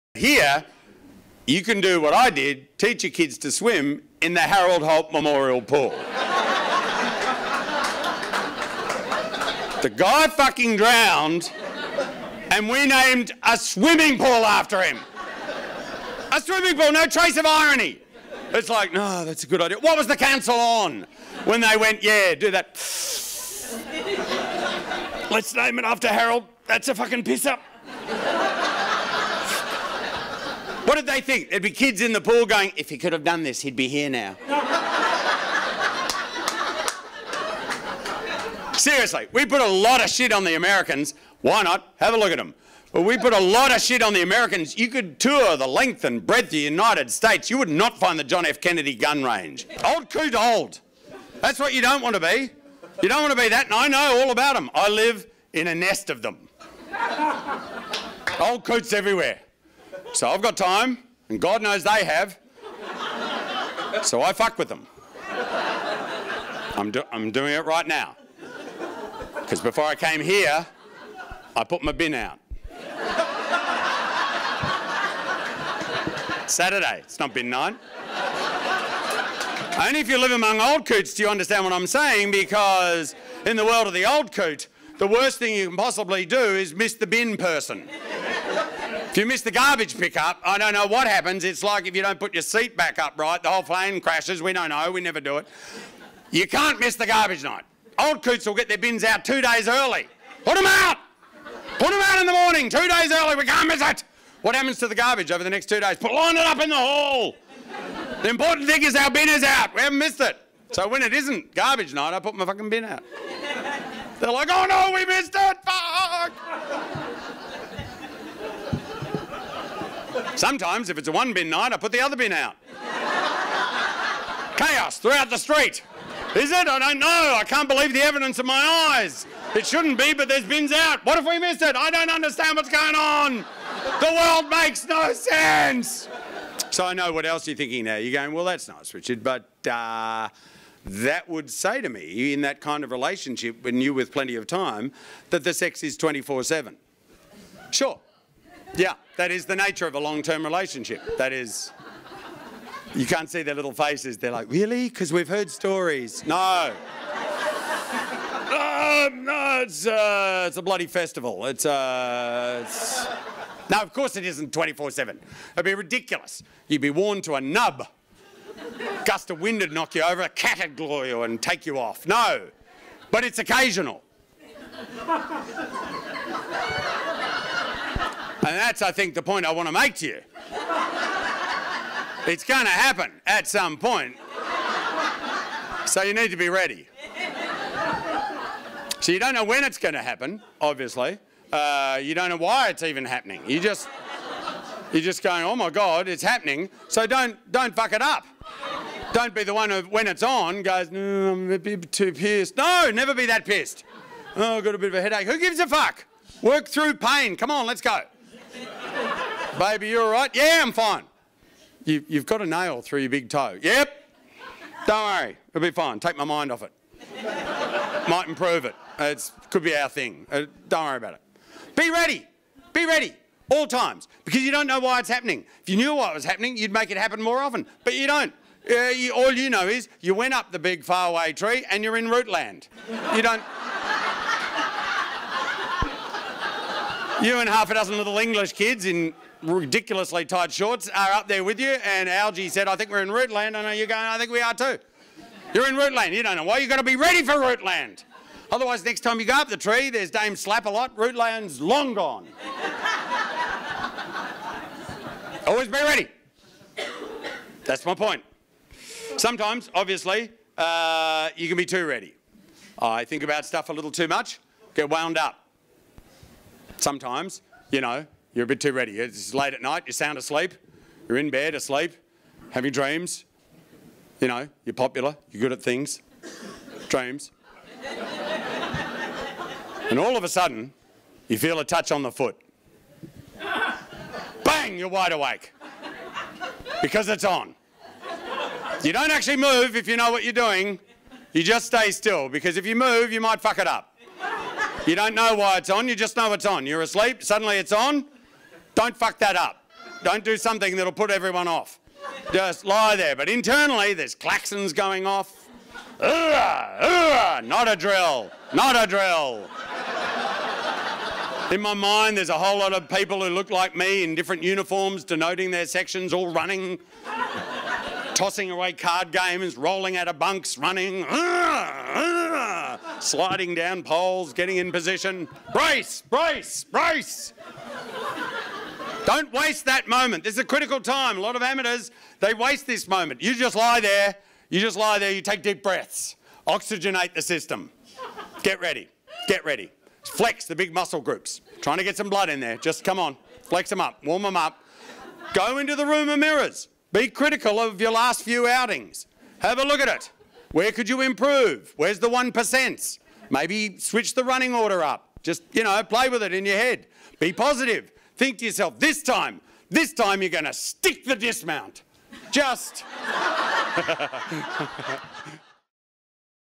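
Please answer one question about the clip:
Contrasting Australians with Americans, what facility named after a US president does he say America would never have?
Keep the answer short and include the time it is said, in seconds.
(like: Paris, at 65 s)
John F. Kennedy gun range, at 48 s.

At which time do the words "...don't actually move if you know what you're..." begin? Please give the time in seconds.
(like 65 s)
288 s.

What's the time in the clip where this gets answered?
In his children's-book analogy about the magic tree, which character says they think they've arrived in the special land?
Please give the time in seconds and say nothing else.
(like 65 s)
242 s.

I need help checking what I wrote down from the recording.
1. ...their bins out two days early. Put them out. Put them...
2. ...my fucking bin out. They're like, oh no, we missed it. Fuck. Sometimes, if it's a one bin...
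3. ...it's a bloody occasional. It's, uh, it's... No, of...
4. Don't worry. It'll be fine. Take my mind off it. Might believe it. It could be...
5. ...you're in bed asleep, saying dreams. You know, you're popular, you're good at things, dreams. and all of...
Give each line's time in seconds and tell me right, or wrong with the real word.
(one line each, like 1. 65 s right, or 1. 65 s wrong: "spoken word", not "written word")
1. 98 s right
2. 112 s right
3. 160 s wrong: "festival", not "occasional"
4. 214 s wrong: "improve", not "believe"
5. 271 s wrong: "having", not "saying".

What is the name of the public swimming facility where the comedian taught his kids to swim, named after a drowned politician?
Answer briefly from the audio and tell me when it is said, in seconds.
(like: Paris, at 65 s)
Harold Holt Memorial Pool, at 4 s.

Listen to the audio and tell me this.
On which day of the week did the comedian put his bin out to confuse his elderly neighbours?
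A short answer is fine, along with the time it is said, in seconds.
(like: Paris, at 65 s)
Saturday, at 76 s.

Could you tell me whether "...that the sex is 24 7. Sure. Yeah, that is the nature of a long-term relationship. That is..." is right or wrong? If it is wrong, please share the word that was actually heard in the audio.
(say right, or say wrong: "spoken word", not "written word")
right.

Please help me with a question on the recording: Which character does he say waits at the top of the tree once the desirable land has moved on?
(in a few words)
Dame Slap.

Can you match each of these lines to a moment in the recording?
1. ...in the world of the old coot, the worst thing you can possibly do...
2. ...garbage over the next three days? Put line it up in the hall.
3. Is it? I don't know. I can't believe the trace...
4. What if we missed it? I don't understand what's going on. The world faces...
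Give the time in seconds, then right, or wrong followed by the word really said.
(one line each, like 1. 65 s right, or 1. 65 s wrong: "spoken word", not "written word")
1. 83 s right
2. 104 s wrong: "two", not "three"
3. 126 s wrong: "evidence", not "trace"
4. 131 s wrong: "makes", not "faces".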